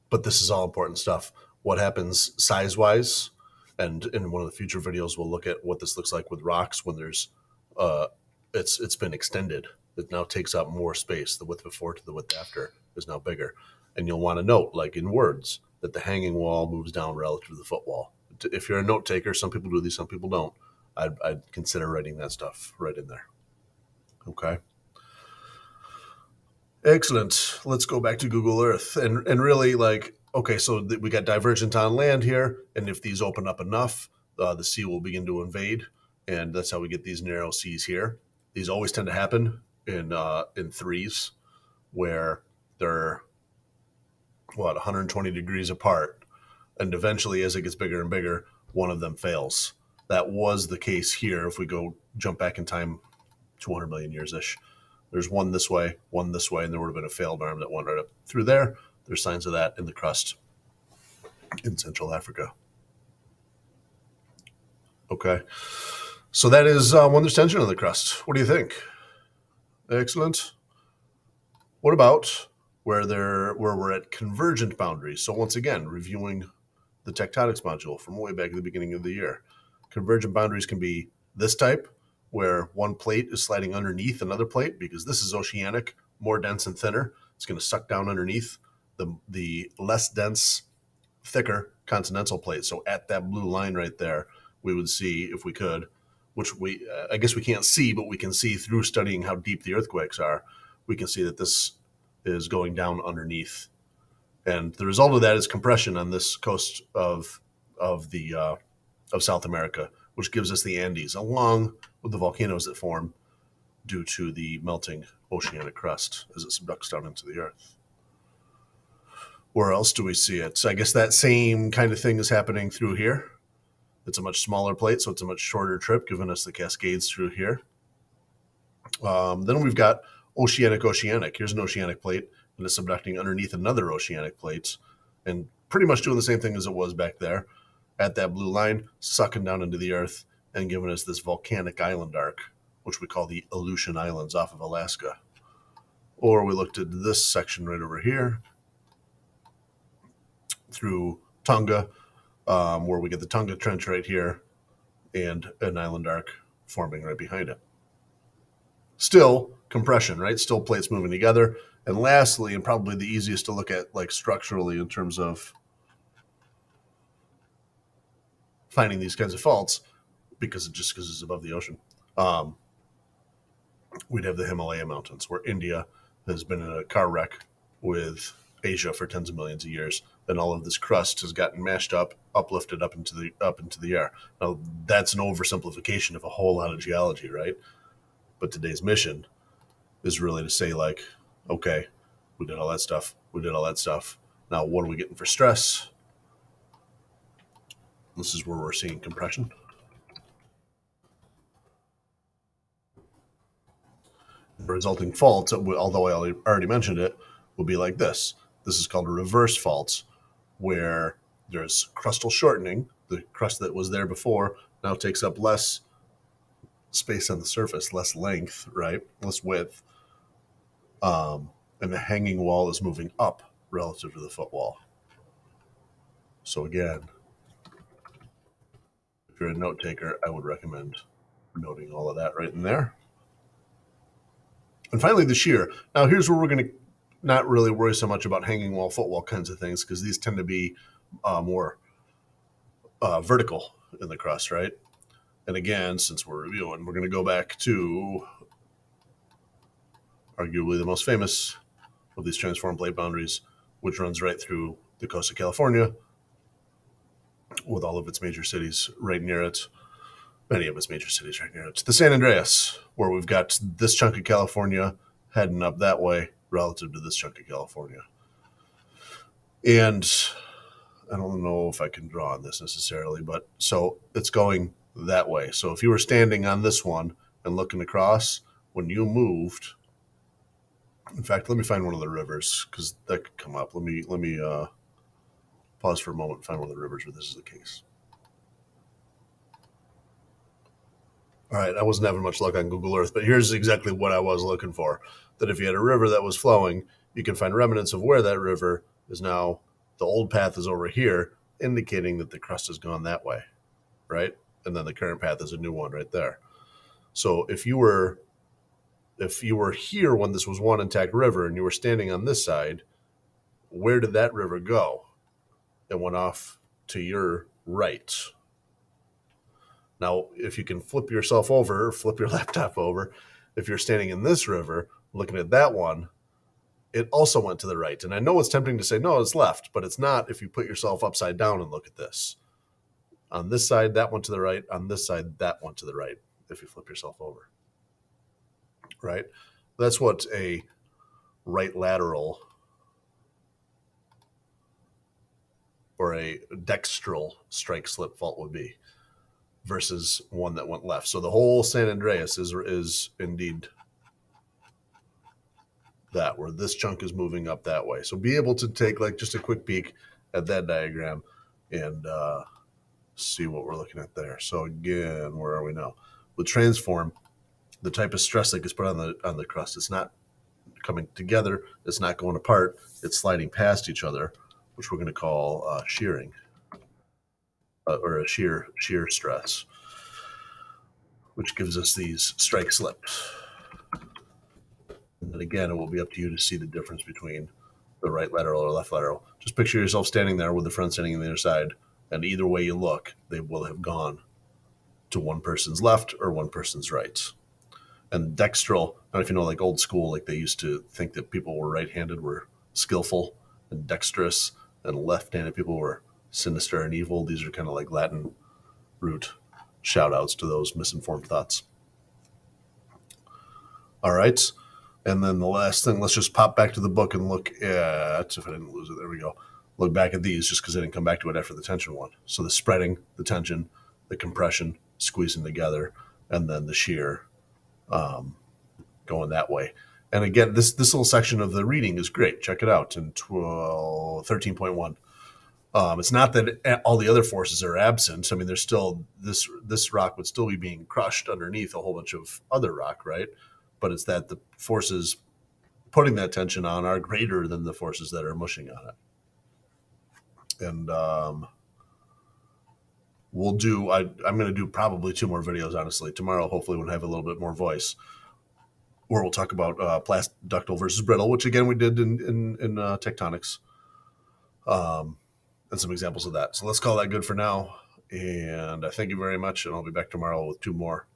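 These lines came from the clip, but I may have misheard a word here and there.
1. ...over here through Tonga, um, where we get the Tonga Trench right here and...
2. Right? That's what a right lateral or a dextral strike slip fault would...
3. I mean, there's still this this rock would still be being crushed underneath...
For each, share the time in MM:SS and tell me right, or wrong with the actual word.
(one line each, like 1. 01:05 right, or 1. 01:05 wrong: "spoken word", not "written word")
1. 02:27 right
2. 05:39 right
3. 07:18 right.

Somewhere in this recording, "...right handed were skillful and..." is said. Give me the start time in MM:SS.
06:41.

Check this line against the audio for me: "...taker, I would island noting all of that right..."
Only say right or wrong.
wrong.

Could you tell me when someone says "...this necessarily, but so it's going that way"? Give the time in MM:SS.
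04:32.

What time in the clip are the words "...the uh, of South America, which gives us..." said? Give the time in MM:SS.
01:48.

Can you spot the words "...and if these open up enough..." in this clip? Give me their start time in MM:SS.
00:32.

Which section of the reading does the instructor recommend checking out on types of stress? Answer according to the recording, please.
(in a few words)
13.1.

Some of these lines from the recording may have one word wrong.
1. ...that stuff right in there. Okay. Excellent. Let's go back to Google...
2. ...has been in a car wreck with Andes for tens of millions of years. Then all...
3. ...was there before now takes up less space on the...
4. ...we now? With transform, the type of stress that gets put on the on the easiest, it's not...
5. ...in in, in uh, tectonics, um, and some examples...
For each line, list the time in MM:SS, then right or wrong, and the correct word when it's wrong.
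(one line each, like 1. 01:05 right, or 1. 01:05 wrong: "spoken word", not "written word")
1. 00:22 right
2. 02:56 wrong: "Asia", not "Andes"
3. 03:33 right
4. 06:05 wrong: "crust", not "easiest"
5. 07:41 right.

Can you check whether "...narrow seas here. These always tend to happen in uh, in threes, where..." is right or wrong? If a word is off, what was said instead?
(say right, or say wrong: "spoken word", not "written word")
right.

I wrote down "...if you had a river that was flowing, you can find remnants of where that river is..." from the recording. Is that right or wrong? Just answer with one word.
right.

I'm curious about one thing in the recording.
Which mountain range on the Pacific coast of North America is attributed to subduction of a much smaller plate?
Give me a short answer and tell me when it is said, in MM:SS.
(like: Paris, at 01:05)
Cascades, at 02:06.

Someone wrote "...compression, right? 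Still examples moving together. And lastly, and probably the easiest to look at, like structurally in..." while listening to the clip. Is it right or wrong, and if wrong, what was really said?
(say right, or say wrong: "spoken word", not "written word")
wrong: "plates", not "examples".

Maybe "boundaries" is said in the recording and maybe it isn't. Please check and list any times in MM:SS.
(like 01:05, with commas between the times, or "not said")
01:14, 01:20, 04:12.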